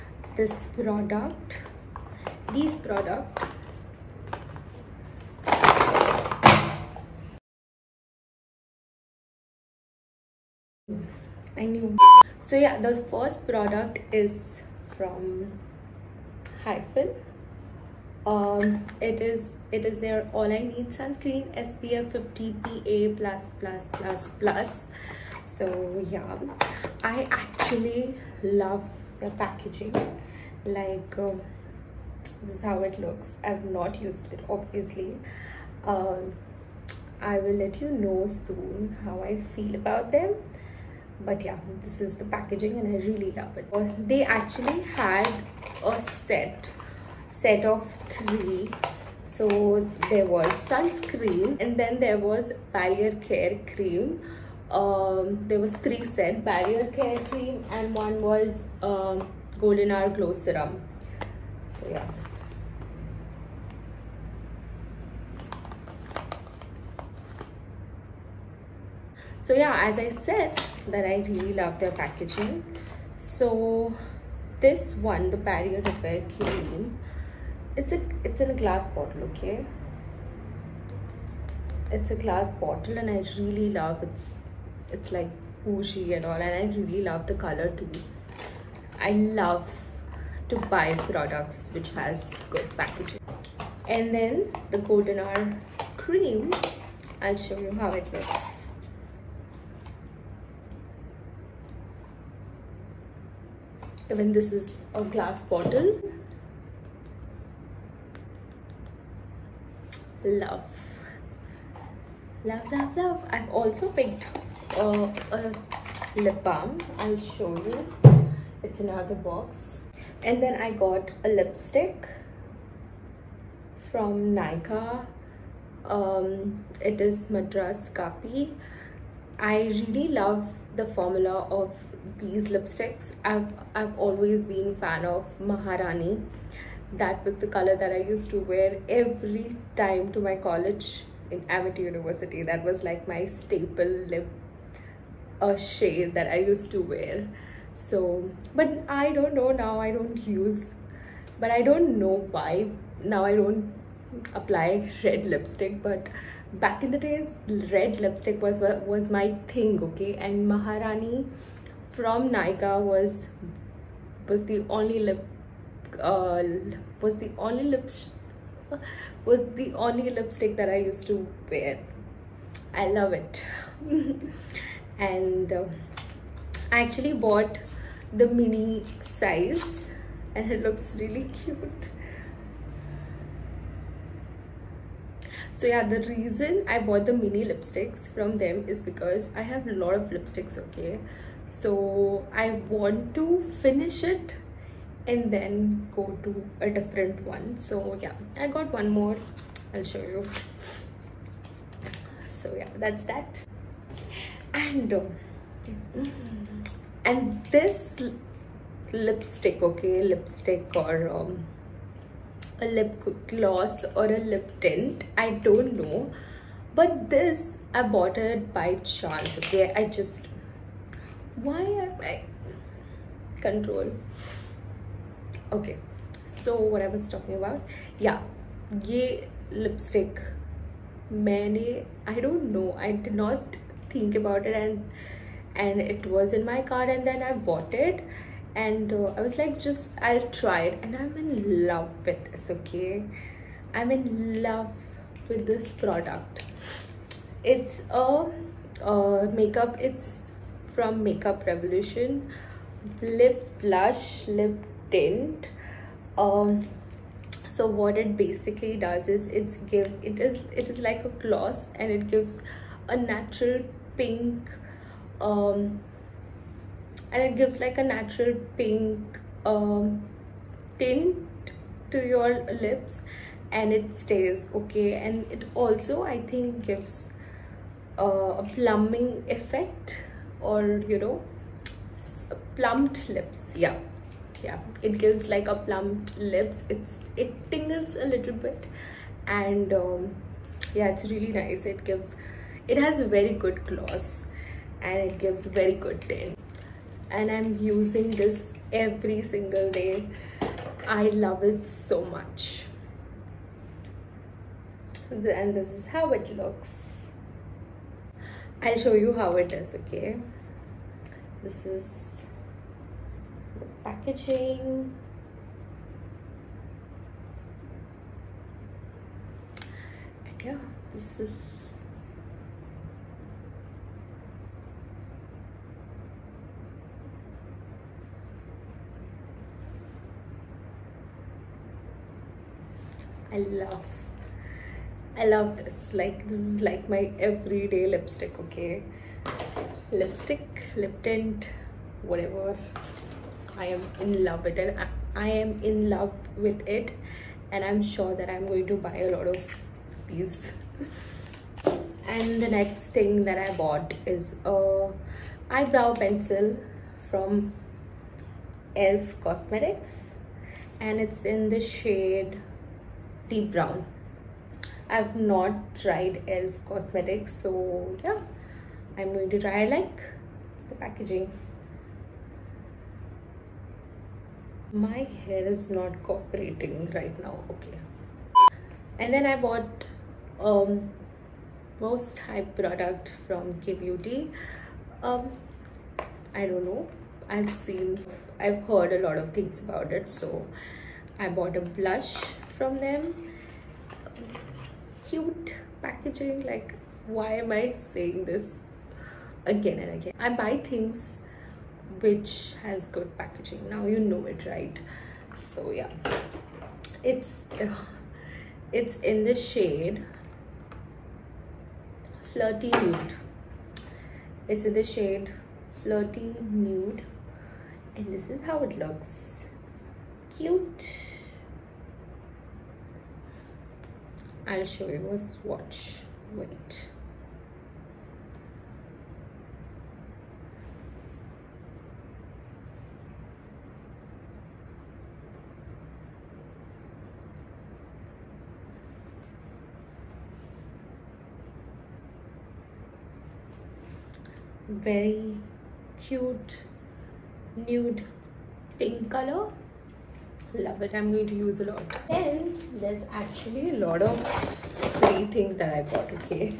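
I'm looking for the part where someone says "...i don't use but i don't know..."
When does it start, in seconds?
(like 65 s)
149 s.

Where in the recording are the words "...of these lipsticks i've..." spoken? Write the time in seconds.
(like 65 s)
131 s.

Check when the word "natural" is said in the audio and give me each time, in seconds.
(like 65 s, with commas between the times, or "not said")
262 s, 267 s.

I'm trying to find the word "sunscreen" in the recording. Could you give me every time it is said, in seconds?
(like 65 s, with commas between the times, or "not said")
20 s, 50 s.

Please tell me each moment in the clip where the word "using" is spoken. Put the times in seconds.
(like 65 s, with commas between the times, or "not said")
297 s.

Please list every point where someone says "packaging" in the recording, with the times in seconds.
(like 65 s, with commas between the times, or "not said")
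29 s, 42 s, 71 s, 92 s, 313 s, 370 s, 395 s, 403 s.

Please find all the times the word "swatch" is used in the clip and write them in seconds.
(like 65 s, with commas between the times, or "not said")
425 s.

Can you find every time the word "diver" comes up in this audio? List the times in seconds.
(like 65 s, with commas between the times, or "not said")
not said.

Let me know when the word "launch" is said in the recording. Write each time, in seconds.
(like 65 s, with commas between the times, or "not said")
not said.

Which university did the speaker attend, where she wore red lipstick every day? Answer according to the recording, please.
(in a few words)
Amity University.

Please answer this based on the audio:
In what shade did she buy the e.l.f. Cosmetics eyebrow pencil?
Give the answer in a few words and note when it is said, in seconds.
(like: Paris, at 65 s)
Deep brown, at 363 s.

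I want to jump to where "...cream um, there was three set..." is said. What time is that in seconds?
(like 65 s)
53 s.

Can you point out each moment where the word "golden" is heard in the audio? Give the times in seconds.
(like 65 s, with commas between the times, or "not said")
59 s, 94 s.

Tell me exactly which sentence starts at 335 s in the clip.
Like, this is like my everyday lipstick, okay?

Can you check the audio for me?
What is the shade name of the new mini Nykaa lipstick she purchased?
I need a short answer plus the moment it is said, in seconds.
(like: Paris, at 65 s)
Madras Kapi, at 127 s.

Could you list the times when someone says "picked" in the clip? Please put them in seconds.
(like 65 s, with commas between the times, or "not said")
113 s.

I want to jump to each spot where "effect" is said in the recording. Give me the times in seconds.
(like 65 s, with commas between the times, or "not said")
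279 s.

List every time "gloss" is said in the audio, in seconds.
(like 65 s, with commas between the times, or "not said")
213 s, 261 s, 293 s.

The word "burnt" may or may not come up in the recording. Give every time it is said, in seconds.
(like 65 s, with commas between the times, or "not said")
not said.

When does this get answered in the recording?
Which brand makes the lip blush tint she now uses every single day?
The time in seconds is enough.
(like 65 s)
251 s.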